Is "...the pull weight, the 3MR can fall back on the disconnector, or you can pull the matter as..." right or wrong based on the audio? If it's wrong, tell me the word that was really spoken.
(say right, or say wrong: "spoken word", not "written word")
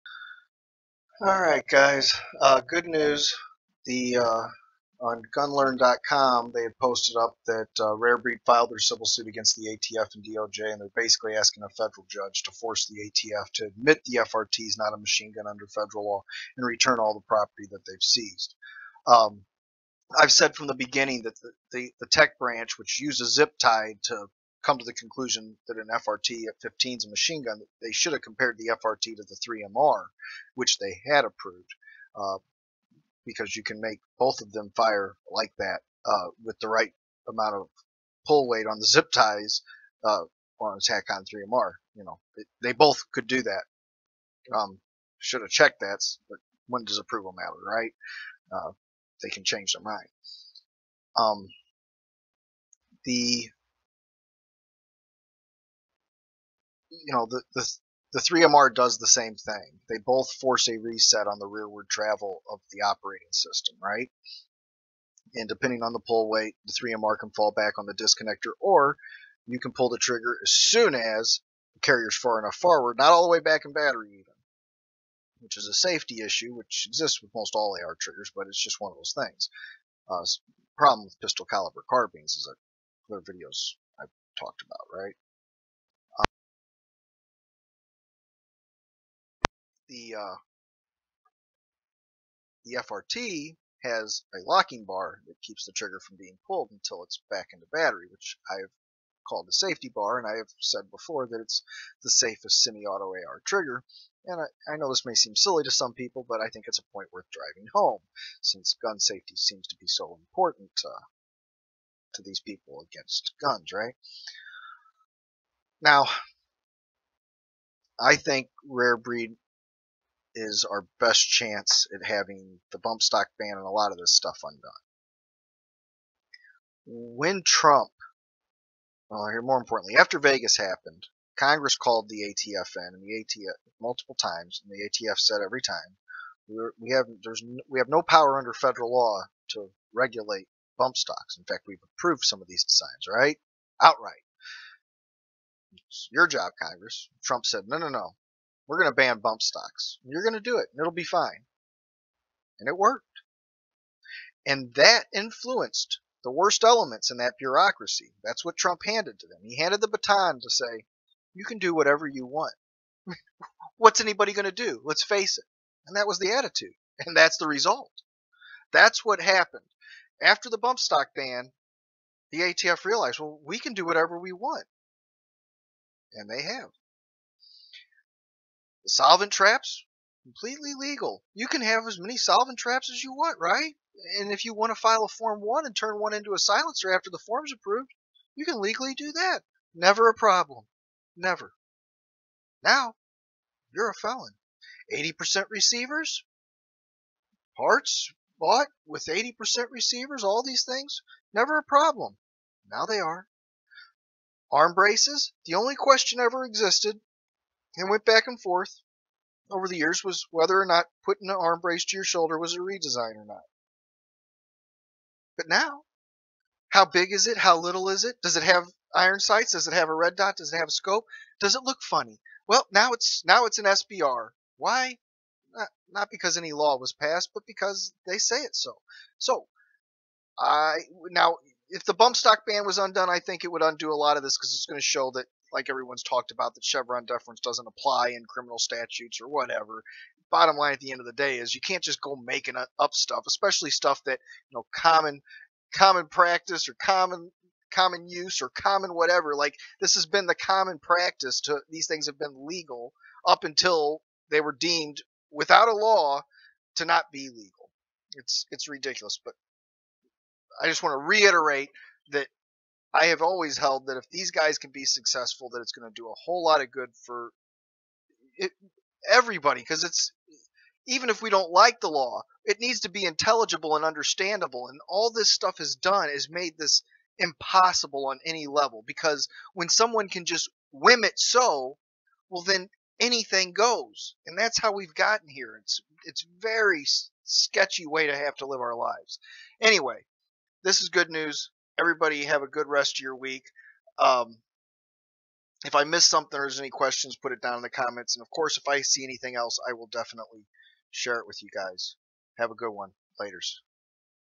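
wrong: "trigger", not "matter".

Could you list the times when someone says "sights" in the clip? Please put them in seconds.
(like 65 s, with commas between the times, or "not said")
219 s.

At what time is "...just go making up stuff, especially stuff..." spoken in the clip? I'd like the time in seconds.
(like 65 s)
241 s.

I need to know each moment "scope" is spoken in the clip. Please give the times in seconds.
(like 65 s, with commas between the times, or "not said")
220 s.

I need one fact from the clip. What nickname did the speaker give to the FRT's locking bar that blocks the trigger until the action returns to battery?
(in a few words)
safety bar.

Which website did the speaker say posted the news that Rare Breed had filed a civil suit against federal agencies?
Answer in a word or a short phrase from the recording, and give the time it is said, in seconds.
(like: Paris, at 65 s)
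gunlearn.com, at 5 s.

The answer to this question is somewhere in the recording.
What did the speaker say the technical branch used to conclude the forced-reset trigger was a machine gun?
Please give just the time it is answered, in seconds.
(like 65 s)
23 s.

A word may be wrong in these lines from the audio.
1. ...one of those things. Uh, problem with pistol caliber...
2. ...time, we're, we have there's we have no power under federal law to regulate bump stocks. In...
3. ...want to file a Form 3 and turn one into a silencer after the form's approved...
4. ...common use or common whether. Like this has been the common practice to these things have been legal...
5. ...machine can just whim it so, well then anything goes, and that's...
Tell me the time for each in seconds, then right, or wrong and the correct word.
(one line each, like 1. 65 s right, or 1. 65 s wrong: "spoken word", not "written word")
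1. 78 s right
2. 135 s right
3. 184 s wrong: "1", not "3"
4. 247 s wrong: "whatever", not "whether"
5. 279 s wrong: "someone", not "machine".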